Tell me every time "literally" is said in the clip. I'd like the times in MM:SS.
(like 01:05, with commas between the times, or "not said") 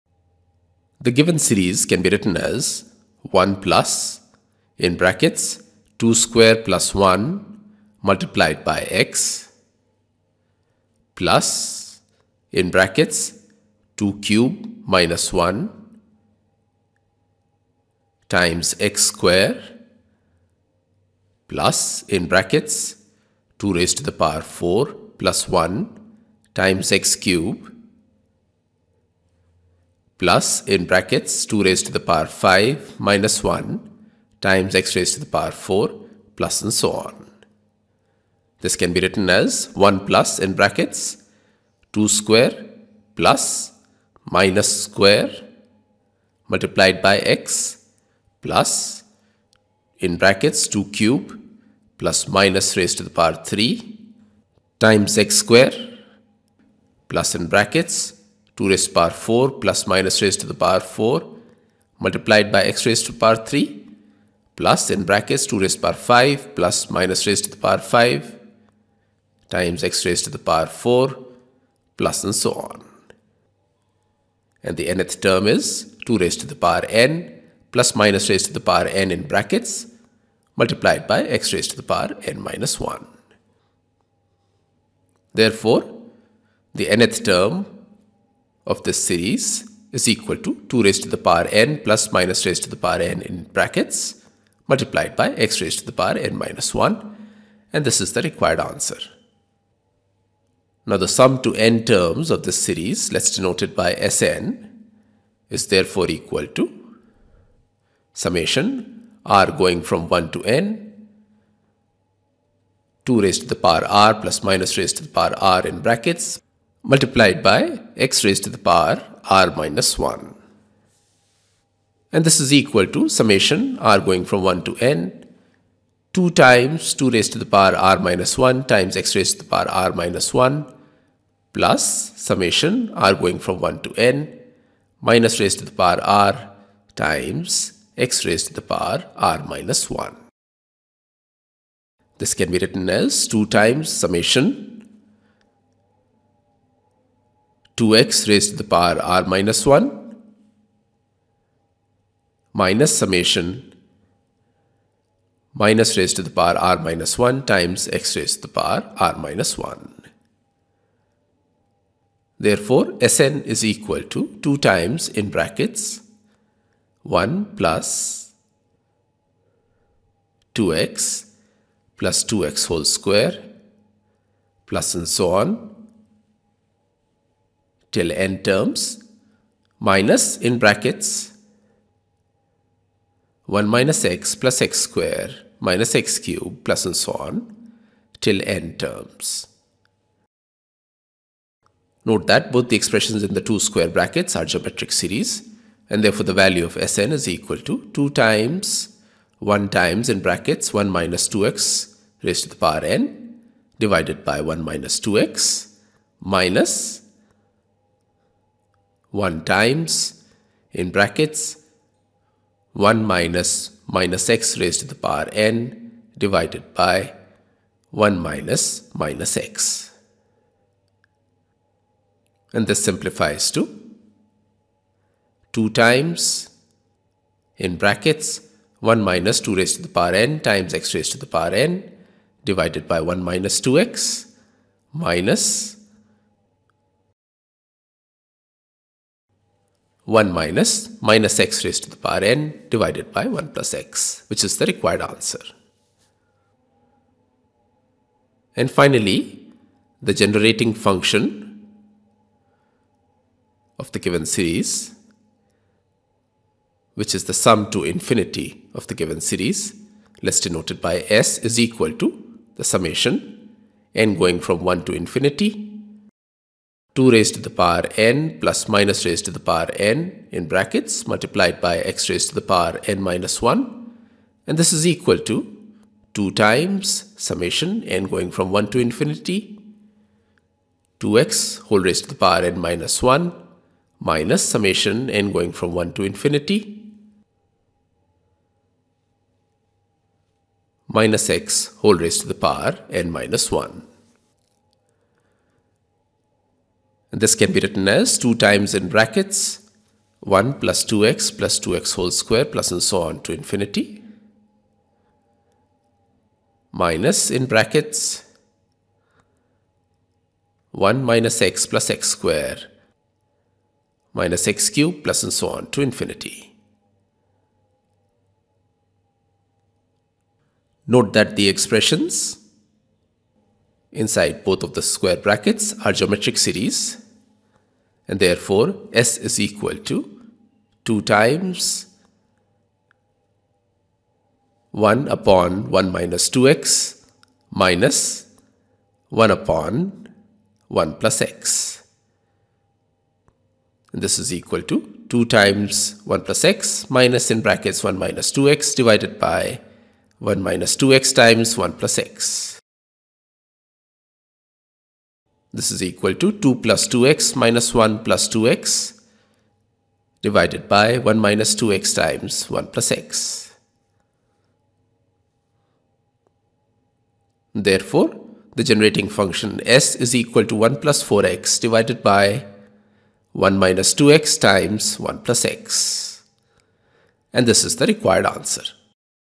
not said.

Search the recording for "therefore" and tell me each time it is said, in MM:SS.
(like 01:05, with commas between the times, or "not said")
01:25, 01:45, 02:42, 03:16, 05:28, 06:07.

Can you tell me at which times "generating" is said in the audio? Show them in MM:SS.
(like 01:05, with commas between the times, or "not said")
04:10, 06:08.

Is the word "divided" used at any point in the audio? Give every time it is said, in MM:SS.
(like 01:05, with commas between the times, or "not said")
03:23, 03:36, 03:52, 04:02, 05:48, 06:00, 06:11.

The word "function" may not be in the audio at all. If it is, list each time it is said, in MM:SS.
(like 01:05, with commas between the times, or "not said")
04:10, 06:09.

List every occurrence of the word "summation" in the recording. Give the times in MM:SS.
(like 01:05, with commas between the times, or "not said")
01:48, 02:03, 02:12, 02:24, 02:32, 04:22, 04:37, 04:44.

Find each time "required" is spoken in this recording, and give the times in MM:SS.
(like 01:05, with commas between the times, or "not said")
01:38, 04:04, 06:17.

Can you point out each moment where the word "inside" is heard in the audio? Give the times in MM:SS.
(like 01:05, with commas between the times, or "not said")
05:23.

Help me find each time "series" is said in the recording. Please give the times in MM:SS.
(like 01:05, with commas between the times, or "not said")
00:01, 01:29, 01:42, 03:14, 04:14, 04:19, 05:26.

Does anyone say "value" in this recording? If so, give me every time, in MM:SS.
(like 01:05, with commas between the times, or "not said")
03:16.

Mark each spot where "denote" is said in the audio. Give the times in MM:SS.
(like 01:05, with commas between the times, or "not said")
01:43, 04:20.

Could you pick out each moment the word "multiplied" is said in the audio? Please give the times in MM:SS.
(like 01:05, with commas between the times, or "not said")
00:08, 00:46, 01:02, 01:20, 01:34, 01:56, 04:31.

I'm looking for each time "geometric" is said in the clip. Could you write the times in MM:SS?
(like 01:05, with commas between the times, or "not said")
03:14, 05:25.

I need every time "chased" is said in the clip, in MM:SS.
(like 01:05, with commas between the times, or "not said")
not said.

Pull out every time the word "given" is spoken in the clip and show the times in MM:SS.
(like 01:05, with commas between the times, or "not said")
00:01, 04:13, 04:18.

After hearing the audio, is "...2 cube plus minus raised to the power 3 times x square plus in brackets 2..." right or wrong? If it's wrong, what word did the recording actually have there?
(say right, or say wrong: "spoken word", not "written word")
right.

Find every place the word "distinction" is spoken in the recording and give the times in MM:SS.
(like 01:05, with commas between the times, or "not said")
not said.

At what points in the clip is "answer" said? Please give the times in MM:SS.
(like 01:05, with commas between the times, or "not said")
01:38, 04:05, 06:18.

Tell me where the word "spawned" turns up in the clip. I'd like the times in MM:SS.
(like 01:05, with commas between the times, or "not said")
not said.